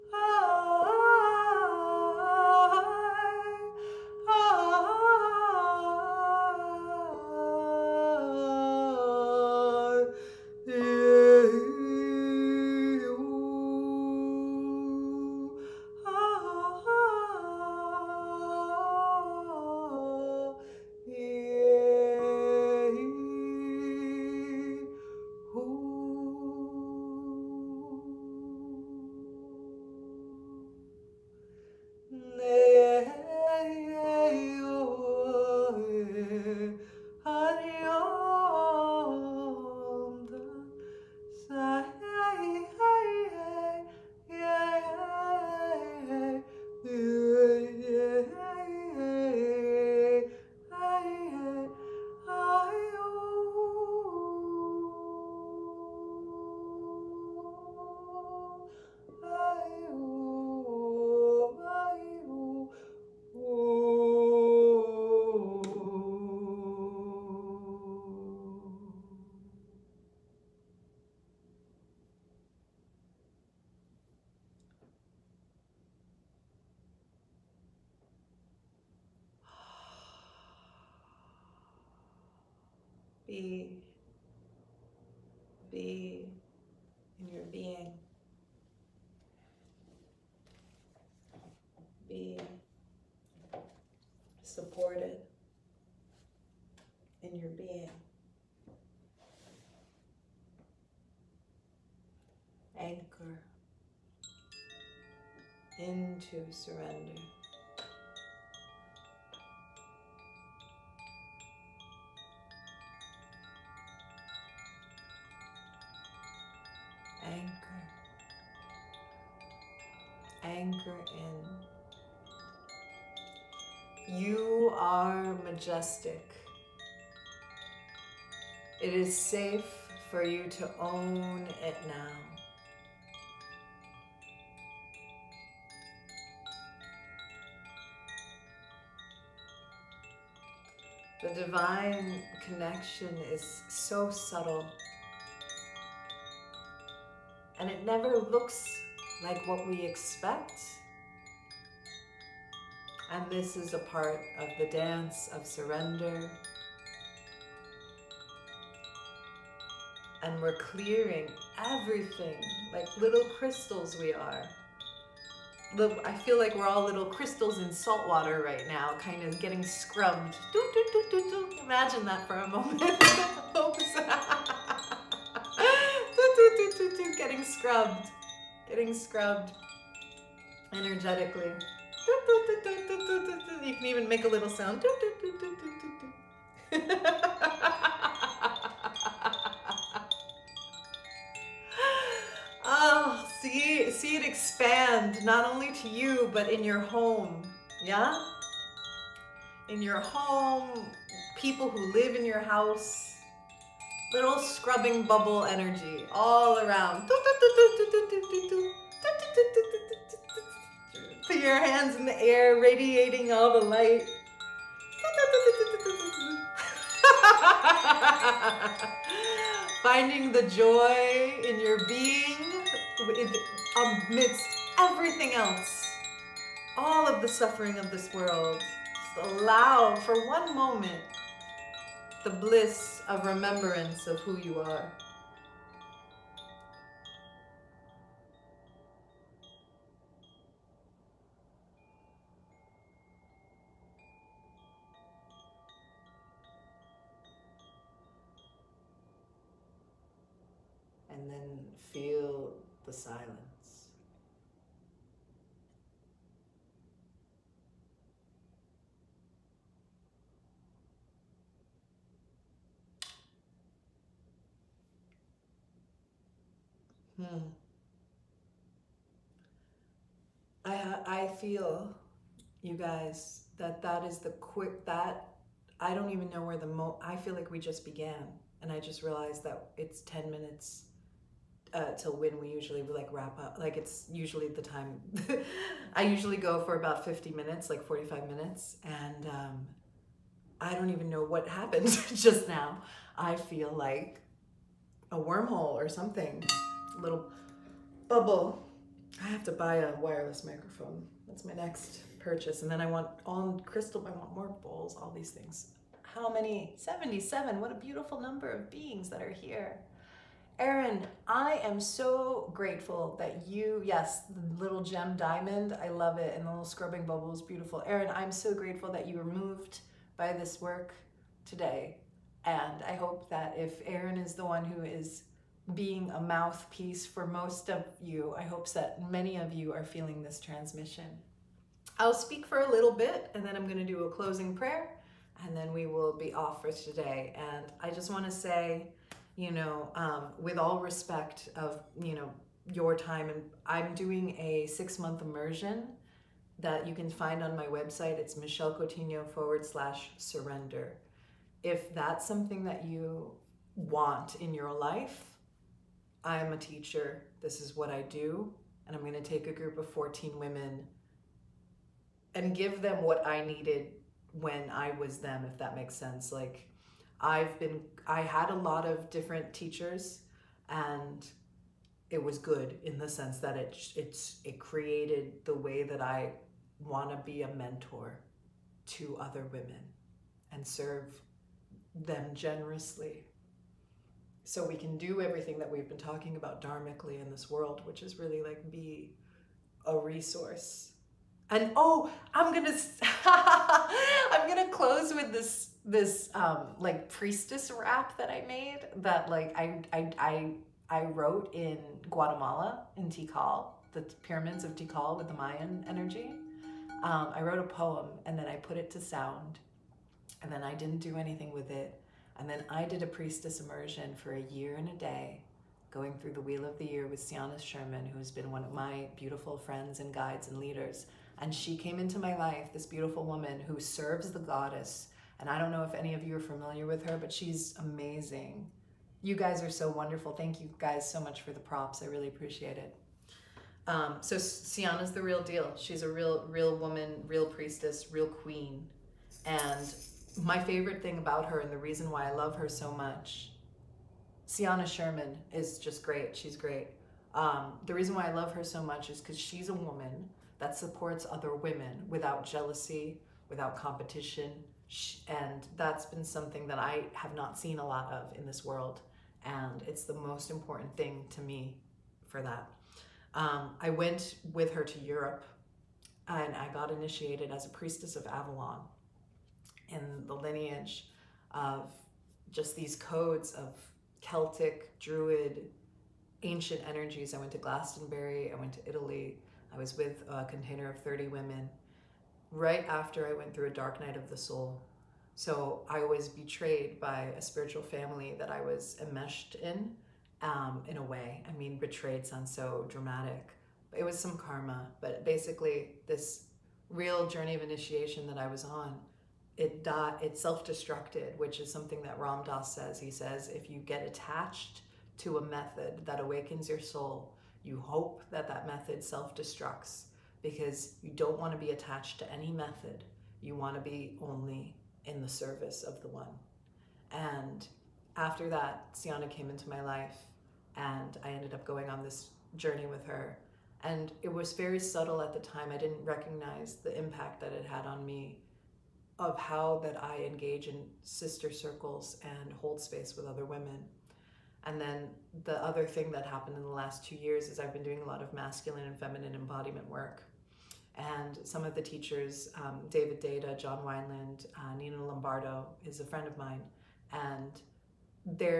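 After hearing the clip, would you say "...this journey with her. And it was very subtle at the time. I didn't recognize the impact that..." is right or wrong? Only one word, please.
right.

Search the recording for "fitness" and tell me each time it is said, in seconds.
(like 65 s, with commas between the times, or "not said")
not said.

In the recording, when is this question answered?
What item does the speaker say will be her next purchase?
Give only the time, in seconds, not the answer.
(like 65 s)
299 s.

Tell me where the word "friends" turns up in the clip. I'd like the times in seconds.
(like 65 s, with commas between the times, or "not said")
419 s, 546 s.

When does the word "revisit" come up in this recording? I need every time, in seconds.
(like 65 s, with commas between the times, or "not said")
not said.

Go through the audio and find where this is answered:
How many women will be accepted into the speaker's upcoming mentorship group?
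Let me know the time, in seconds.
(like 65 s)
359 s.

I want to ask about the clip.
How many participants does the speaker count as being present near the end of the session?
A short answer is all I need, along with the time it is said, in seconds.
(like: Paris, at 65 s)
77, at 306 s.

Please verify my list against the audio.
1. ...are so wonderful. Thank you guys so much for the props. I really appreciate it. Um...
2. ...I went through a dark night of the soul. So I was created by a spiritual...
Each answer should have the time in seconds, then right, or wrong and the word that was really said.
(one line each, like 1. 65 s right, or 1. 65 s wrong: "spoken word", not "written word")
1. 429 s right
2. 483 s wrong: "betrayed", not "created".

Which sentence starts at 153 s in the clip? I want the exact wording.
And this is a part of the dance of surrender.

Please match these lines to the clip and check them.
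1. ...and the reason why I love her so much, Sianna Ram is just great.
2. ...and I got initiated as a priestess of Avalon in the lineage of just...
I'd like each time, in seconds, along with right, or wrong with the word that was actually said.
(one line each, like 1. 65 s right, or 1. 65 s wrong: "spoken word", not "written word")
1. 441 s wrong: "Sherman", not "Ram"
2. 466 s right.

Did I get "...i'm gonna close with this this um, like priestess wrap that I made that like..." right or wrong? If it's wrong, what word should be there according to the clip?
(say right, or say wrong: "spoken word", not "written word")
right.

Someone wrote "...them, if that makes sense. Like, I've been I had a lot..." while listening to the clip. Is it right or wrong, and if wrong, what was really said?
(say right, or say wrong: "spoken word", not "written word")
right.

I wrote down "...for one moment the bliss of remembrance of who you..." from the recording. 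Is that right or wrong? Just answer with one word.
right.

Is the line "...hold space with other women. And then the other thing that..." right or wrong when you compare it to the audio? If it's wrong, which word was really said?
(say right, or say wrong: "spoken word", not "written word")
right.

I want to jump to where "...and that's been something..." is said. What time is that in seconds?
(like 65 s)
455 s.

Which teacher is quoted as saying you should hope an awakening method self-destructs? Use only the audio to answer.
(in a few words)
Ram Dass.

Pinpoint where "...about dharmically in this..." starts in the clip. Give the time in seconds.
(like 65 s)
386 s.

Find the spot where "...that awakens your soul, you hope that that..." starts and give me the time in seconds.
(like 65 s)
506 s.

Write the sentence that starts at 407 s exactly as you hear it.
Um, I wrote a poem and then I put it to sound, and then I didn't do anything with it.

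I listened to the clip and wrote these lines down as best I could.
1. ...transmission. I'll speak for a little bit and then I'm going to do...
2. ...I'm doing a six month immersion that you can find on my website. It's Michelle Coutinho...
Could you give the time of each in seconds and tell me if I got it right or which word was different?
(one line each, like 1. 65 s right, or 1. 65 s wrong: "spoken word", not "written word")
1. 330 s right
2. 343 s right.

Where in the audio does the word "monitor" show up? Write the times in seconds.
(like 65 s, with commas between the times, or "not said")
not said.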